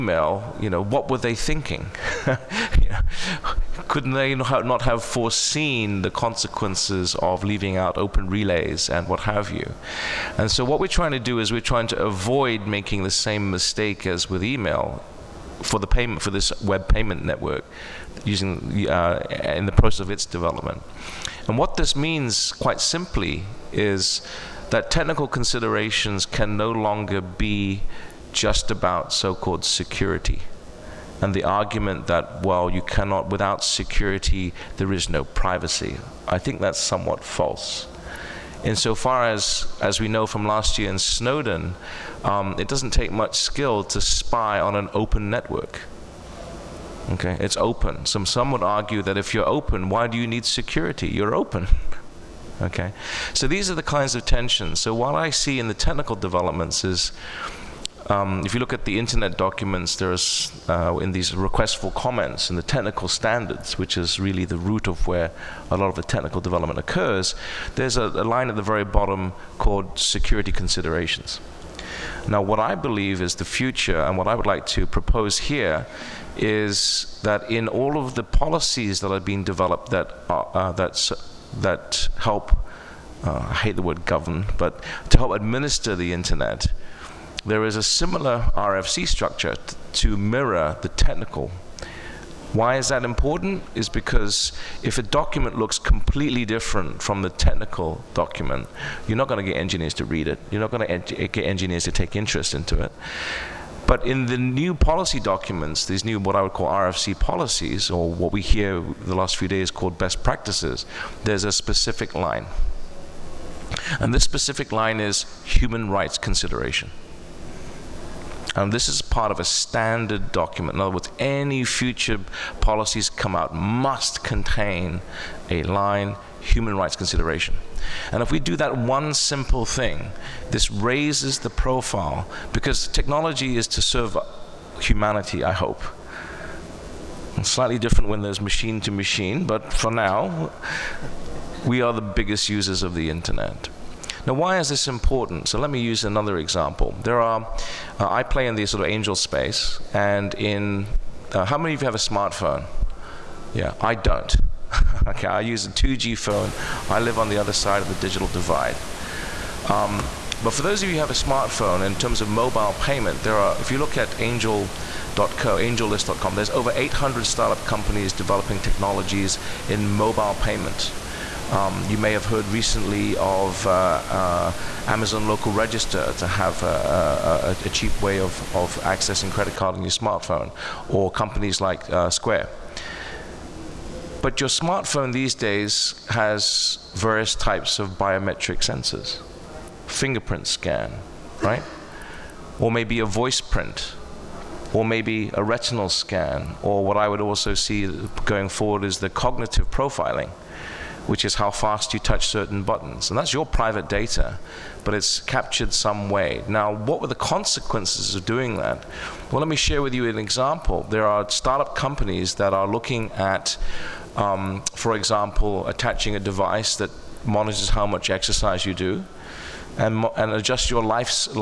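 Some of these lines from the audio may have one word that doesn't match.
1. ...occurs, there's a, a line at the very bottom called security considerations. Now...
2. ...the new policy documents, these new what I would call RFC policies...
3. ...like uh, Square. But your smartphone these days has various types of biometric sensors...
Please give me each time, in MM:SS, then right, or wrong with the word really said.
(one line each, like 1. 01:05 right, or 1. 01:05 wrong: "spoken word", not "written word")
1. 01:06 right
2. 01:44 right
3. 03:01 right.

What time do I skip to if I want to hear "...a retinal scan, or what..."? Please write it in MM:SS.
03:15.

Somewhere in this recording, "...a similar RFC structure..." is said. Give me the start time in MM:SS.
01:27.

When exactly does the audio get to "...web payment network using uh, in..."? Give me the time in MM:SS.
00:16.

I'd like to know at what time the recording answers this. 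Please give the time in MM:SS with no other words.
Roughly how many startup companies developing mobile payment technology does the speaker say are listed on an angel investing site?
02:46.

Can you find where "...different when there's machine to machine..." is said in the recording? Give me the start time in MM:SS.
02:17.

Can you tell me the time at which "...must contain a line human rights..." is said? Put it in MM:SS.
02:03.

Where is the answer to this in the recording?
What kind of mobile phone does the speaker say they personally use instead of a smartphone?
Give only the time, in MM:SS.
02:35.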